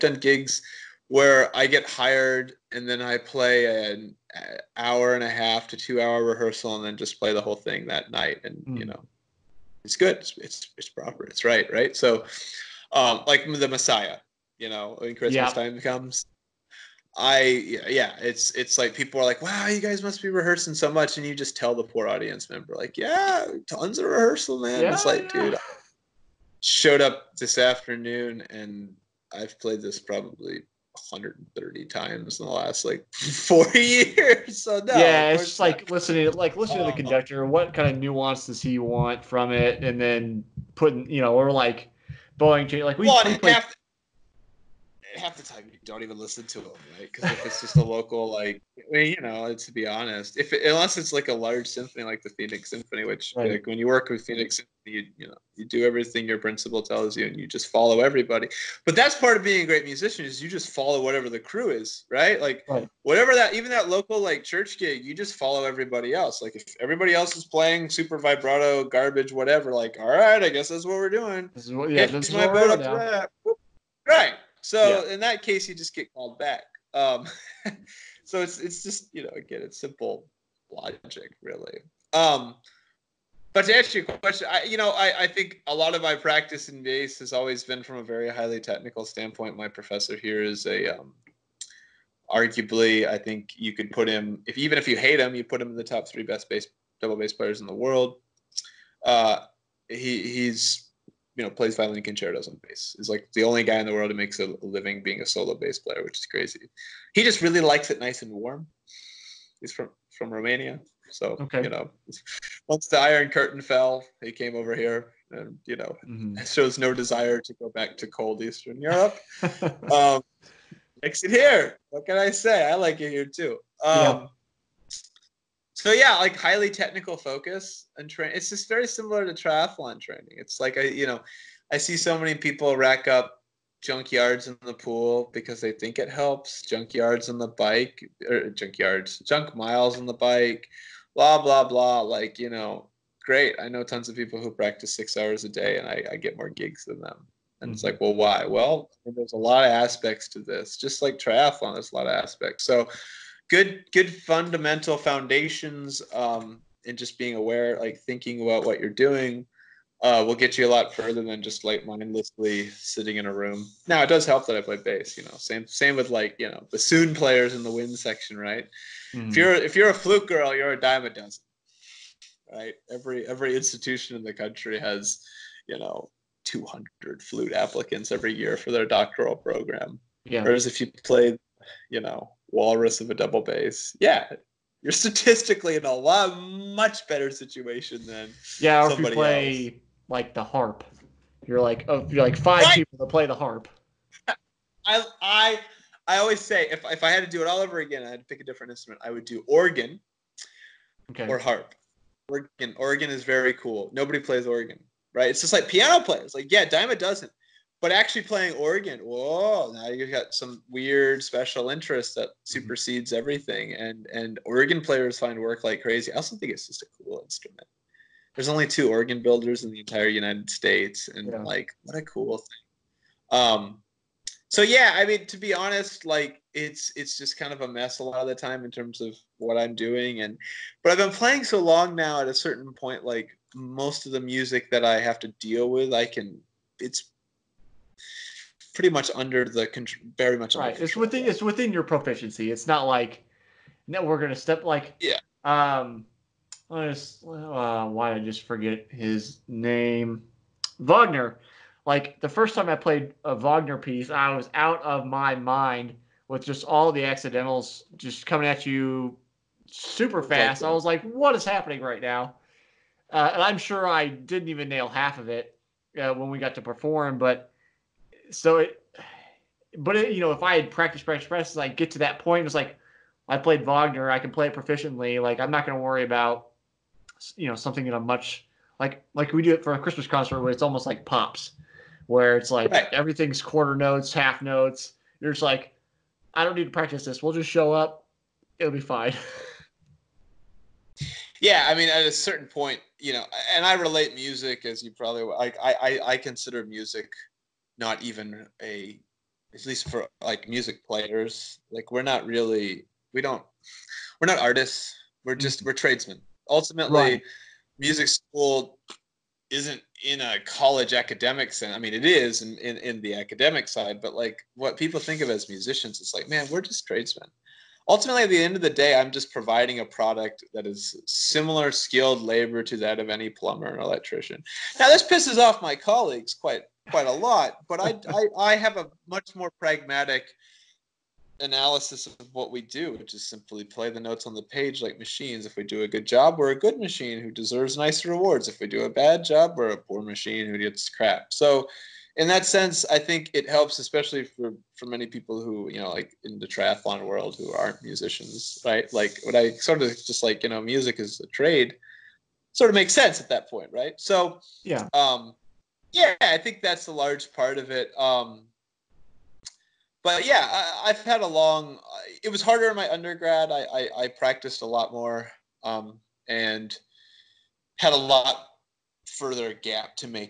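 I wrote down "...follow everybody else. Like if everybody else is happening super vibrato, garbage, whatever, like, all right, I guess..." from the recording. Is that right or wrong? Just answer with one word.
wrong.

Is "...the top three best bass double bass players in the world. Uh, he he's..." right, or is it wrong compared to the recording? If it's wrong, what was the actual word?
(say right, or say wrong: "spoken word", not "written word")
right.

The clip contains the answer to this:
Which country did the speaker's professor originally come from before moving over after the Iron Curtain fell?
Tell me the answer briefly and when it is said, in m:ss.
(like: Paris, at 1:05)
Romania, at 1:50.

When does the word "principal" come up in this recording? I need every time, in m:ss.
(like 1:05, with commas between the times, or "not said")
0:56.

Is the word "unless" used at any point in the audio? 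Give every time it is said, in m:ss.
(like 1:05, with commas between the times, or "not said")
0:50.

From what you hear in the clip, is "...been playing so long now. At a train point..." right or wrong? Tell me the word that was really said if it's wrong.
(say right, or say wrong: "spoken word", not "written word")
wrong: "certain", not "train".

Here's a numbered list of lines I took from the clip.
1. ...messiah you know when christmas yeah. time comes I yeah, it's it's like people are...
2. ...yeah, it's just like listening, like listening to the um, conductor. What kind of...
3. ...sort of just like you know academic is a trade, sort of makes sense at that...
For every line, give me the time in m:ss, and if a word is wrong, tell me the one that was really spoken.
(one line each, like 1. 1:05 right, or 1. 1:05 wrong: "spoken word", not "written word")
1. 0:13 right
2. 0:34 right
3. 5:49 wrong: "music", not "academic".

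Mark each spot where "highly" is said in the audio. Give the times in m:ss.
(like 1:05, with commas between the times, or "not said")
1:28, 2:06.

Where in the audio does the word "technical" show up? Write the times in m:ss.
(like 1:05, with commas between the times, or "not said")
1:28, 2:06.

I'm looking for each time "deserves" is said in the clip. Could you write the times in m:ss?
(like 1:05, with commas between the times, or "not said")
5:37.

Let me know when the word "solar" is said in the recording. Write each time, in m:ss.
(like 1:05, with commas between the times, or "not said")
not said.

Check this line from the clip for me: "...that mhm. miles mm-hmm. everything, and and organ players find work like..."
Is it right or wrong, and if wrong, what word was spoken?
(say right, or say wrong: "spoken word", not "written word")
wrong: "supersedes", not "miles".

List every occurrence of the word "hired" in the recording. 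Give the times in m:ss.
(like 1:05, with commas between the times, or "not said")
0:01.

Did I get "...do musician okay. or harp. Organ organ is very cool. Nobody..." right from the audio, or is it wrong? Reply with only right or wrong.
wrong.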